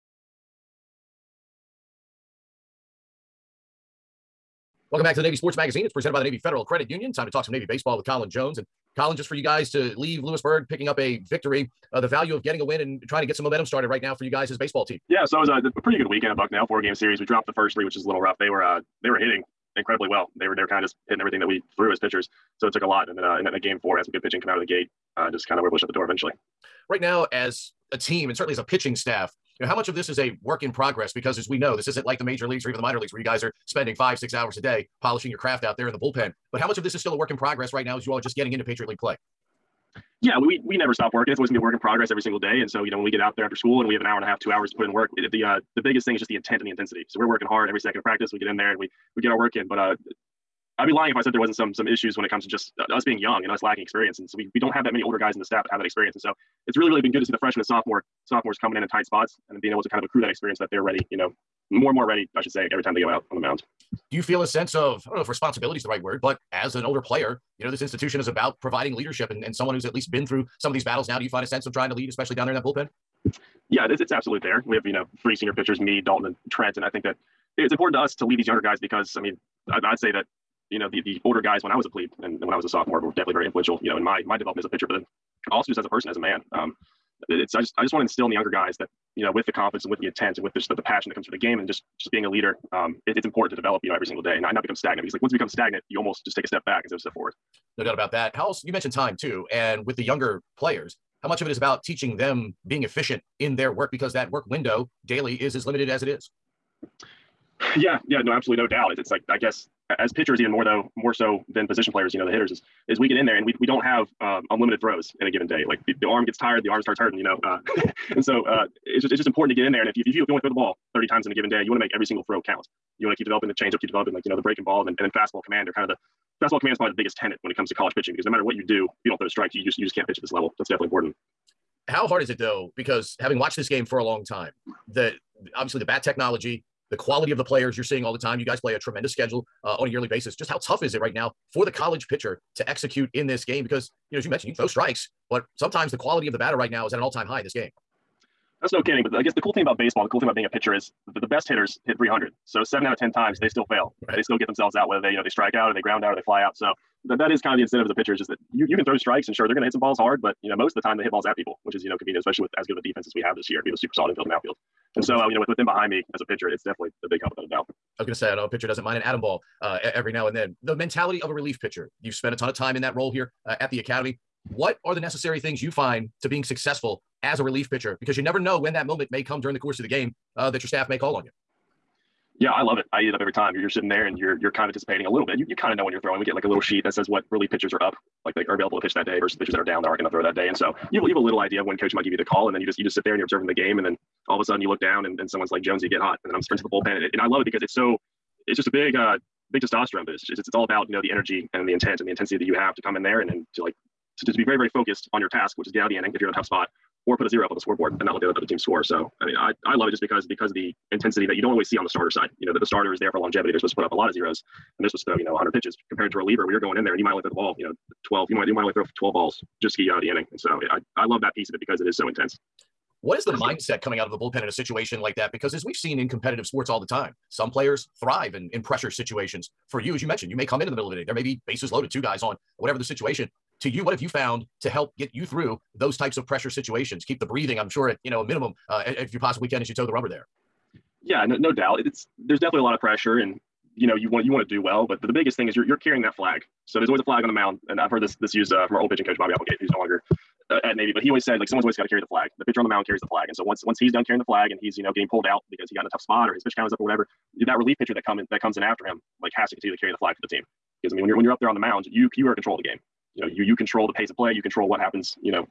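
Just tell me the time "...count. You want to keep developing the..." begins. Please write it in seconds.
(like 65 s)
122 s.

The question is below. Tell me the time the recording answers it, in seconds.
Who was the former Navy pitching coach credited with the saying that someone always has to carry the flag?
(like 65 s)
249 s.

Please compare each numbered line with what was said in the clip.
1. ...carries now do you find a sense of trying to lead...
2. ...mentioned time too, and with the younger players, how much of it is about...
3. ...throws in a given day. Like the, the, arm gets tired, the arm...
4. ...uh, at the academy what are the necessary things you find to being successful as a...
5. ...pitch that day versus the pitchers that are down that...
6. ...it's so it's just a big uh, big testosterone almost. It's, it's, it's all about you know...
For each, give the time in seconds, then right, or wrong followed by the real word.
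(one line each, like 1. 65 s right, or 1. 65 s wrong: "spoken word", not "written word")
1. 70 s wrong: "battles", not "carries"
2. 98 s right
3. 114 s right
4. 173 s right
5. 188 s right
6. 197 s wrong: "boost", not "almost".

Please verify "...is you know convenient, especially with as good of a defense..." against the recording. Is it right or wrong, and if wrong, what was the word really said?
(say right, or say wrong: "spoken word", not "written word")
right.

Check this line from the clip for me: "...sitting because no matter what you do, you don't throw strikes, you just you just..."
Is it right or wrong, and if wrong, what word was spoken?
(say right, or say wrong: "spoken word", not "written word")
wrong: "pitching", not "sitting".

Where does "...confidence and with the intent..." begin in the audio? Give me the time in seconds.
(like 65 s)
89 s.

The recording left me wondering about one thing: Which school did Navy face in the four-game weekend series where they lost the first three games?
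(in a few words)
Bucknell.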